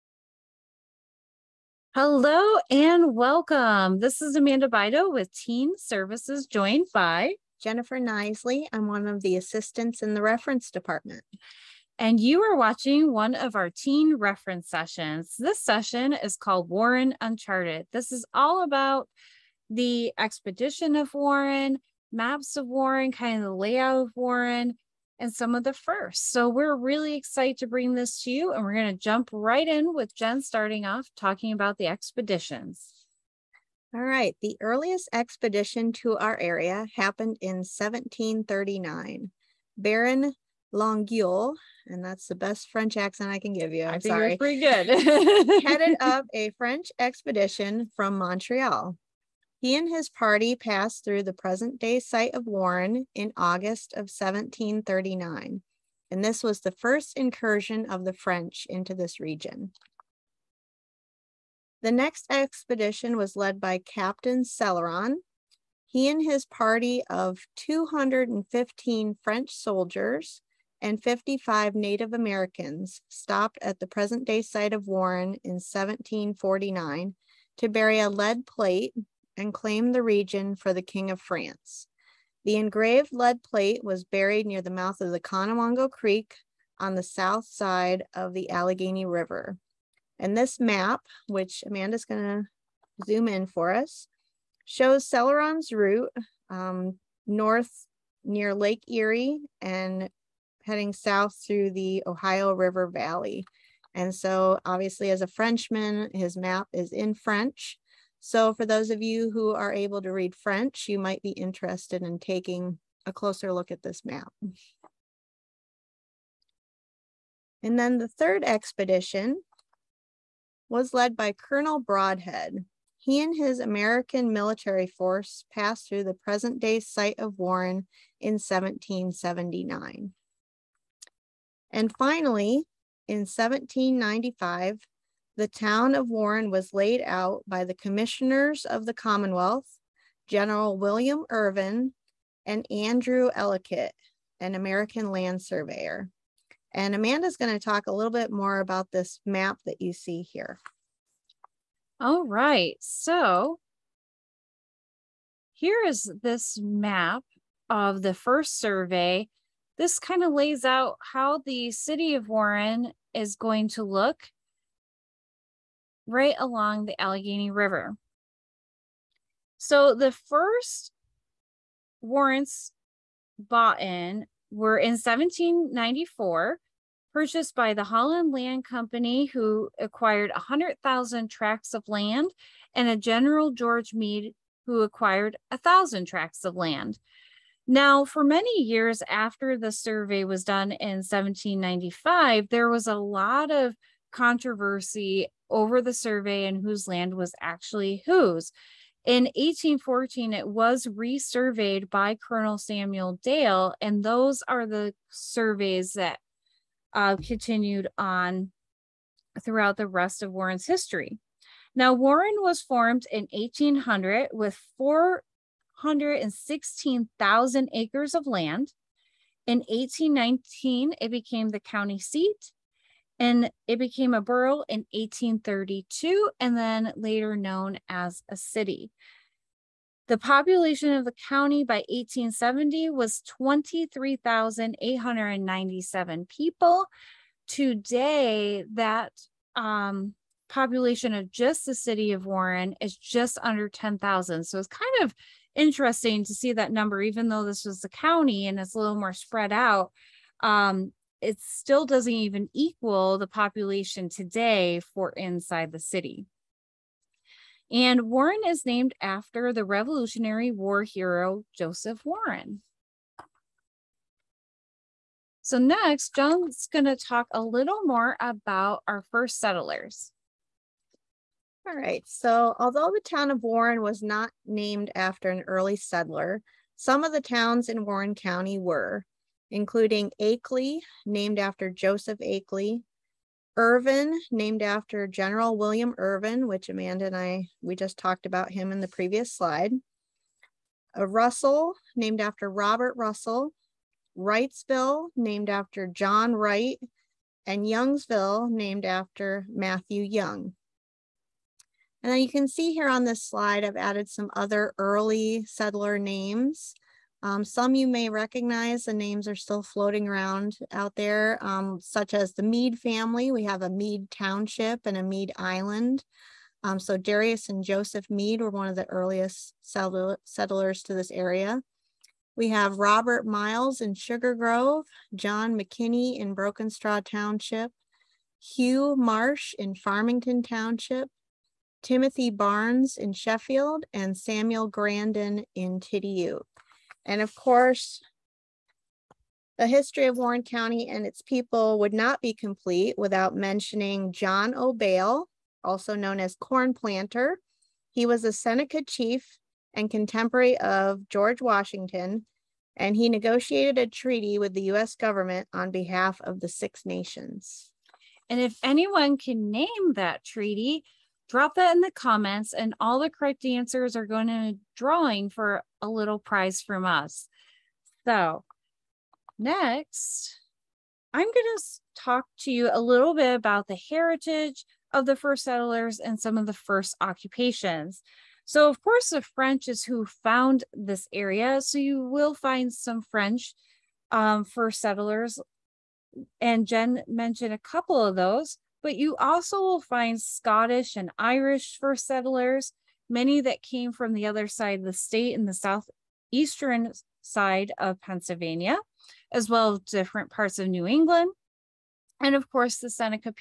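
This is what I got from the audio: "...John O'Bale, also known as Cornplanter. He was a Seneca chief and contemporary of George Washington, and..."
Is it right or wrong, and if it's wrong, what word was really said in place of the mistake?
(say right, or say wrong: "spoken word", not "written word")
right.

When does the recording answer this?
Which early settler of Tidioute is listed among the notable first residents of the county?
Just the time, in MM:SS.
05:34.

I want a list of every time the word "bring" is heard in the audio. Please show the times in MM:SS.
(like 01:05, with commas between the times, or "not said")
00:27.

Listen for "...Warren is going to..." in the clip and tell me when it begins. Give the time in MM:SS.
02:42.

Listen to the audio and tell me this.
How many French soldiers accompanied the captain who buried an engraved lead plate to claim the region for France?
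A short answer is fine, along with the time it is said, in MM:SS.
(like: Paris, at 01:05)
215, at 01:07.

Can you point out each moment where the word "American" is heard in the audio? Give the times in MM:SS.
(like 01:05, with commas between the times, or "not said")
01:12, 02:03, 02:24.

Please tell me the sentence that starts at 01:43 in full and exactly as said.
And so obviously as a Frenchman, his map is in French.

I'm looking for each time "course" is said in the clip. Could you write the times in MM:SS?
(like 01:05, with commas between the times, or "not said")
05:37, 06:18, 06:42.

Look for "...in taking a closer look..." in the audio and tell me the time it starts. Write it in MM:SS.
01:52.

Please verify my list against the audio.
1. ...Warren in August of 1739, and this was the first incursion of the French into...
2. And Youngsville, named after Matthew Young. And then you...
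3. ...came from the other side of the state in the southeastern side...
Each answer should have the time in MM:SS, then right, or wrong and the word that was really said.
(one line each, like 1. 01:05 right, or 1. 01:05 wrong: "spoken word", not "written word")
1. 00:52 right
2. 04:57 right
3. 06:33 right.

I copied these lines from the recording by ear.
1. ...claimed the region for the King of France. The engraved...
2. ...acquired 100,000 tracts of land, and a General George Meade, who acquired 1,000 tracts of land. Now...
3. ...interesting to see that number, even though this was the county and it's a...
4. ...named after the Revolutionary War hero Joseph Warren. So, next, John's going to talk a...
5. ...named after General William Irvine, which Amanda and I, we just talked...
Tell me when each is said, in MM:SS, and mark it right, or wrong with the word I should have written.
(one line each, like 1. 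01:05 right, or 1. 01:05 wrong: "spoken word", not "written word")
1. 01:19 right
2. 02:59 right
3. 04:05 right
4. 04:18 right
5. 04:44 right.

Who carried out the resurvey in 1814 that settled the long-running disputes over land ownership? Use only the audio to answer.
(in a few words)
Colonel Samuel Dale.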